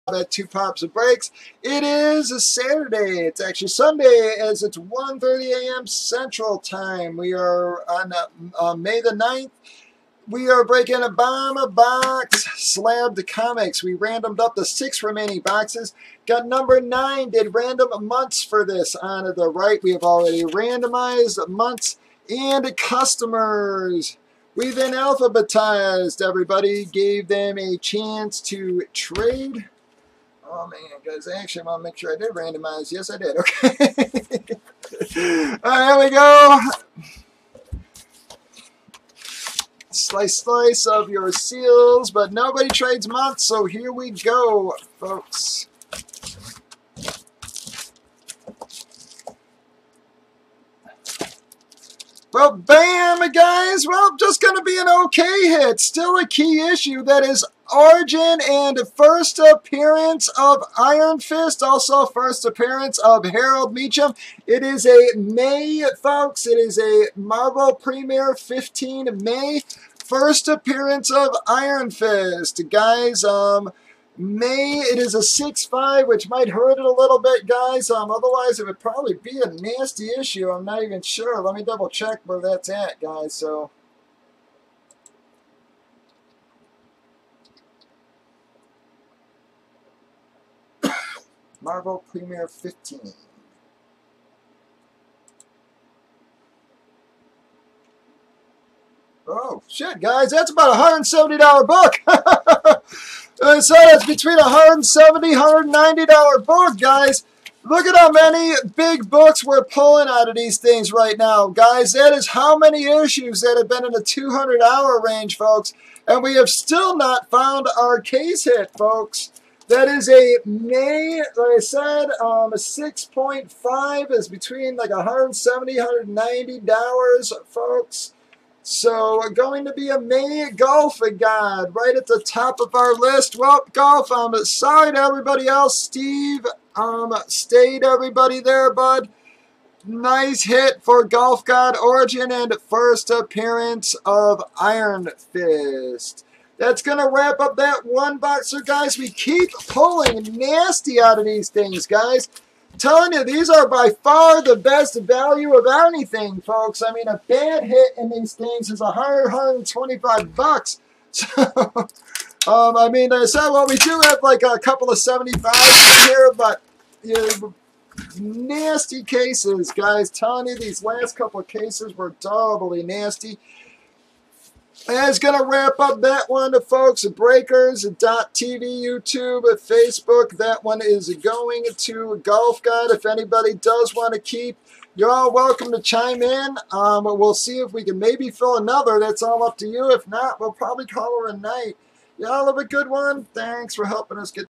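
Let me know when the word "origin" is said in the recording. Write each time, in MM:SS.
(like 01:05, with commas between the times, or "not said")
00:57, 02:21.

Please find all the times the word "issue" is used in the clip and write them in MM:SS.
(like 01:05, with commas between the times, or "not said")
00:56, 01:20, 01:52.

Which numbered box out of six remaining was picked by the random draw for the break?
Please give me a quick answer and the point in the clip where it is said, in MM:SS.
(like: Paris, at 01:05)
9, at 00:16.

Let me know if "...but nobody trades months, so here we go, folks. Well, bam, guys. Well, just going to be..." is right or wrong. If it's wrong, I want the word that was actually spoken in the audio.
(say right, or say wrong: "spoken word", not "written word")
right.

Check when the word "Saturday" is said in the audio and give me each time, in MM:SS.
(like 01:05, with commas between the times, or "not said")
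00:02.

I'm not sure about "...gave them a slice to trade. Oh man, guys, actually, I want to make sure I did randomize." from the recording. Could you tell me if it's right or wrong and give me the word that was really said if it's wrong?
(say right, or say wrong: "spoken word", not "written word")
wrong: "chance", not "slice".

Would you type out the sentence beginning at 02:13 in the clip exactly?
Well, golf, I'm um, sorry to everybody else.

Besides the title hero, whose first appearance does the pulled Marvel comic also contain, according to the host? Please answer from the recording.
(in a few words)
Harold Meachum.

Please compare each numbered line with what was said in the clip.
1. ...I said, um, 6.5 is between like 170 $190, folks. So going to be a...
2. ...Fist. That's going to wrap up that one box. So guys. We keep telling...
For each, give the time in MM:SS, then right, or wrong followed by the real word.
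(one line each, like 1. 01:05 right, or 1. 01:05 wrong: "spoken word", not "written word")
1. 02:01 right
2. 02:25 wrong: "pulling", not "telling".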